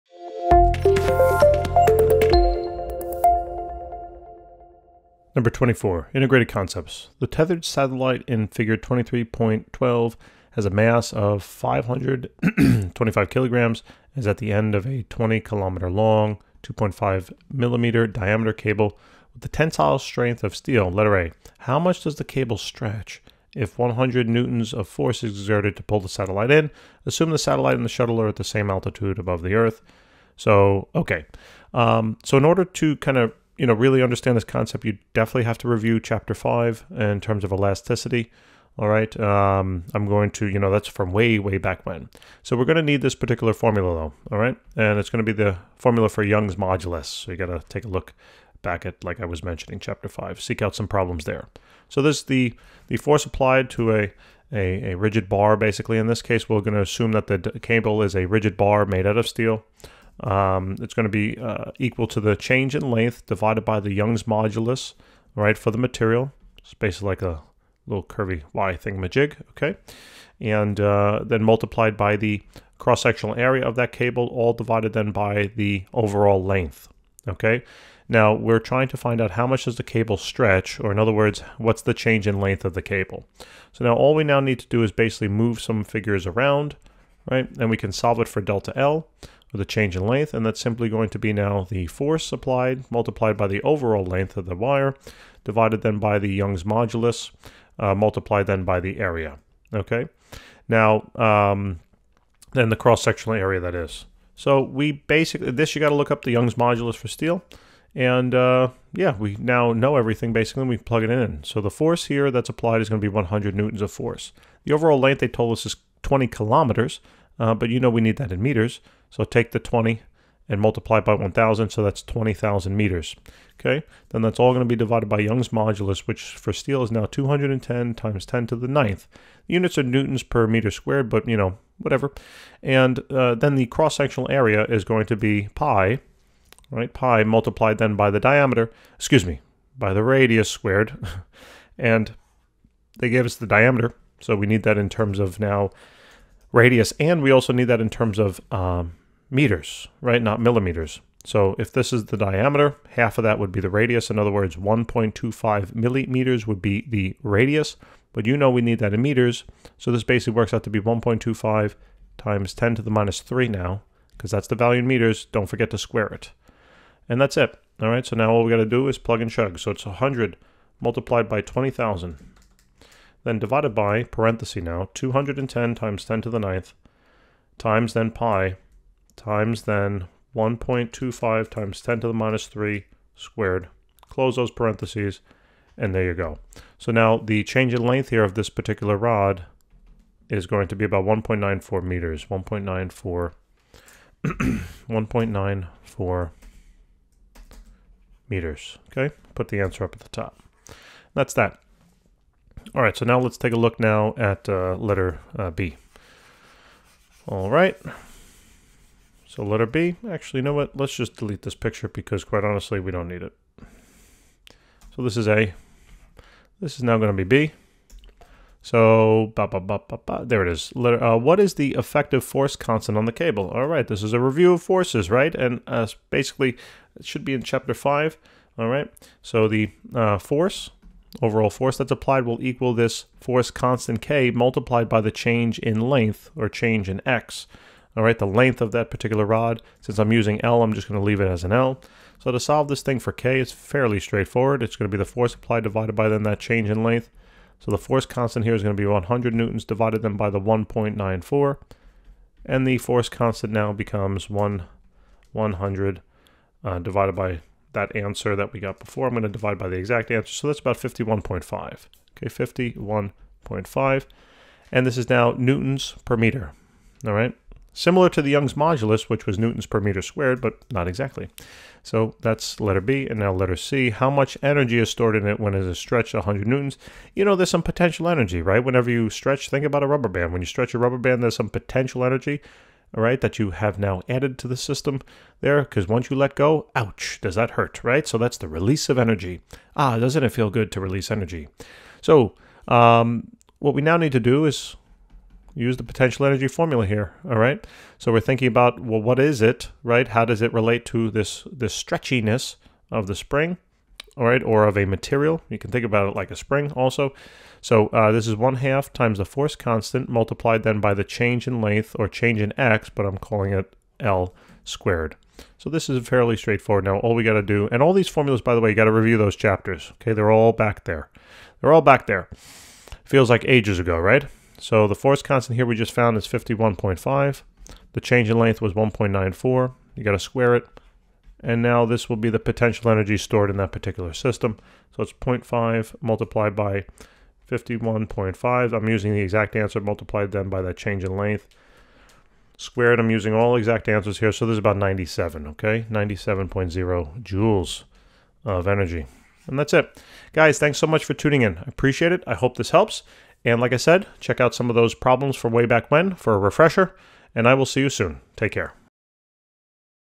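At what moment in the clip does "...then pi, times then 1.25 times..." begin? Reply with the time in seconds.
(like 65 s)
177 s.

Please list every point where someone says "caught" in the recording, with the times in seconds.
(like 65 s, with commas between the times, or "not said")
not said.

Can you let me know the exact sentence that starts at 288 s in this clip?
So that's the release of energy.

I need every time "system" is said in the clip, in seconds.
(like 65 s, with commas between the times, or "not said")
284 s, 334 s.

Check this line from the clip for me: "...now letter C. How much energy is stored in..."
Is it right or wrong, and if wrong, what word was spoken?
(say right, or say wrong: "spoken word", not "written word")
right.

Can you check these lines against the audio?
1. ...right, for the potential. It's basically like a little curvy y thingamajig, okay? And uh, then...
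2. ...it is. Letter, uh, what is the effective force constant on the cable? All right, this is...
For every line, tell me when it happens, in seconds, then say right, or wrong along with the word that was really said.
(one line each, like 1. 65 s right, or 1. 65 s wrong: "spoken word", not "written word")
1. 65 s wrong: "material", not "potential"
2. 220 s right.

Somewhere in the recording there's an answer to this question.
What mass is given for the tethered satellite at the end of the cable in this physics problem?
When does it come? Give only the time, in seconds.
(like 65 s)
11 s.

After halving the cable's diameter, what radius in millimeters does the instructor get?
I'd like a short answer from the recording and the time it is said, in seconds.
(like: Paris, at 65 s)
1.25 millimeters, at 154 s.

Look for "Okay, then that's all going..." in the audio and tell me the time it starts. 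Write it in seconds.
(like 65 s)
123 s.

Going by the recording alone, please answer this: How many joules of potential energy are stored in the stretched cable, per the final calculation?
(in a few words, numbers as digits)
97.0 joules.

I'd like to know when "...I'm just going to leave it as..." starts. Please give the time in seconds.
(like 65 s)
240 s.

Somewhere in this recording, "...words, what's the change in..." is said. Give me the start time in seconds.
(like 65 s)
81 s.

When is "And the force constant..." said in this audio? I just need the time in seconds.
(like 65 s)
252 s.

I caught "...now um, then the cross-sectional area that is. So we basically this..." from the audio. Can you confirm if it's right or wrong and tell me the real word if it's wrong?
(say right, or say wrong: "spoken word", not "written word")
right.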